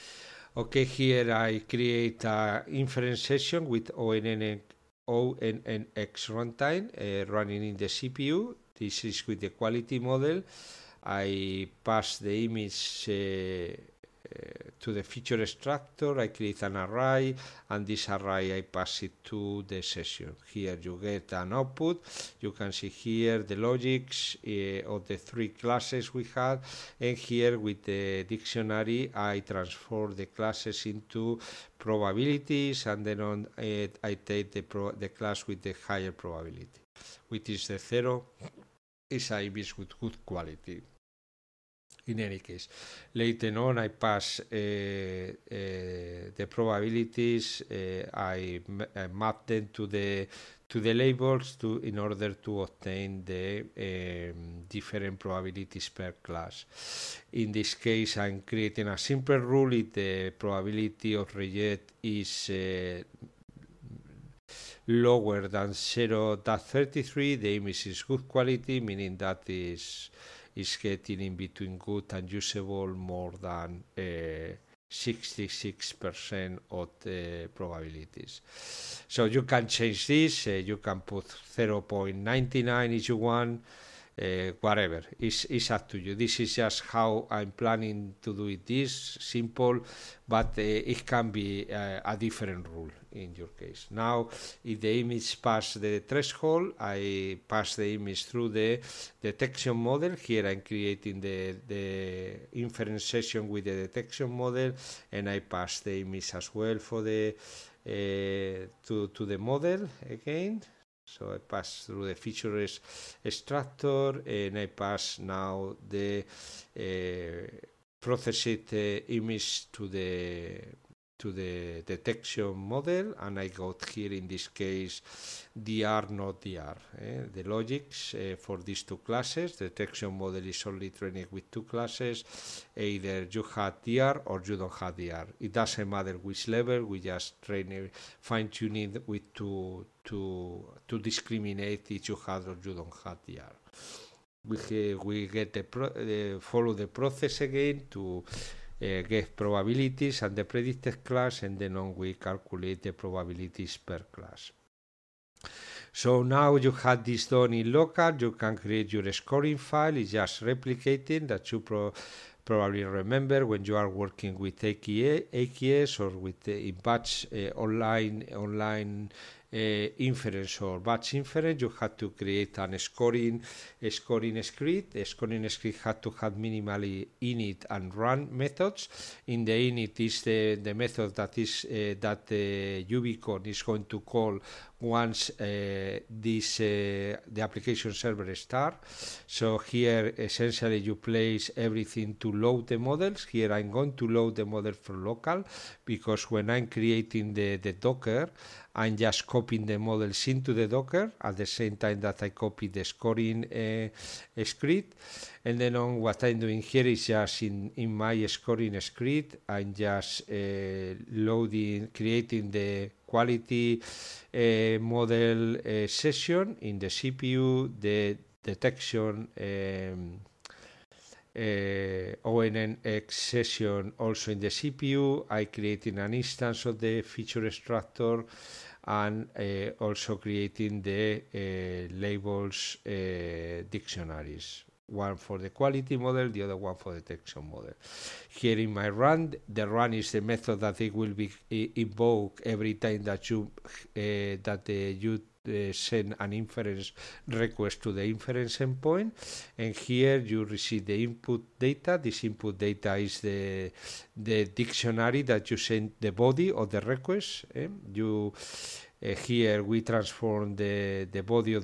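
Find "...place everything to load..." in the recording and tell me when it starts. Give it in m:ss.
3:10.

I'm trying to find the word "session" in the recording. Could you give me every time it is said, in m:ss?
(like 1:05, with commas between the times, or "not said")
0:03, 0:19, 1:43, 3:35, 3:43.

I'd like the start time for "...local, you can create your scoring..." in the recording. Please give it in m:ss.
2:37.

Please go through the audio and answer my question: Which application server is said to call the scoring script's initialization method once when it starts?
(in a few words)
Uvicorn.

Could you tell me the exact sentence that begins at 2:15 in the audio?
It doesn't matter which level, we just train fine-tuning with two, to to discriminate each other.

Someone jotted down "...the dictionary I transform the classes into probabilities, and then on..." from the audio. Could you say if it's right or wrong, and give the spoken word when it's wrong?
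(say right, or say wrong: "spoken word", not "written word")
right.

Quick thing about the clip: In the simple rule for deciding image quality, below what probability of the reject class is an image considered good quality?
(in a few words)
0.33.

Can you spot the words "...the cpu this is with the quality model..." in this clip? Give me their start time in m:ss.
0:07.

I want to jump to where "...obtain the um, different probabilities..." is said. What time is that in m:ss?
0:52.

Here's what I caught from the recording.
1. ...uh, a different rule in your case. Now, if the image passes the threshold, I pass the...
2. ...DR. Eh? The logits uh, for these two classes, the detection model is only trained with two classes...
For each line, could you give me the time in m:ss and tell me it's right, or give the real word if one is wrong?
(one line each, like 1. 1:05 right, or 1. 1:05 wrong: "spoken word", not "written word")
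1. 1:31 right
2. 2:06 right.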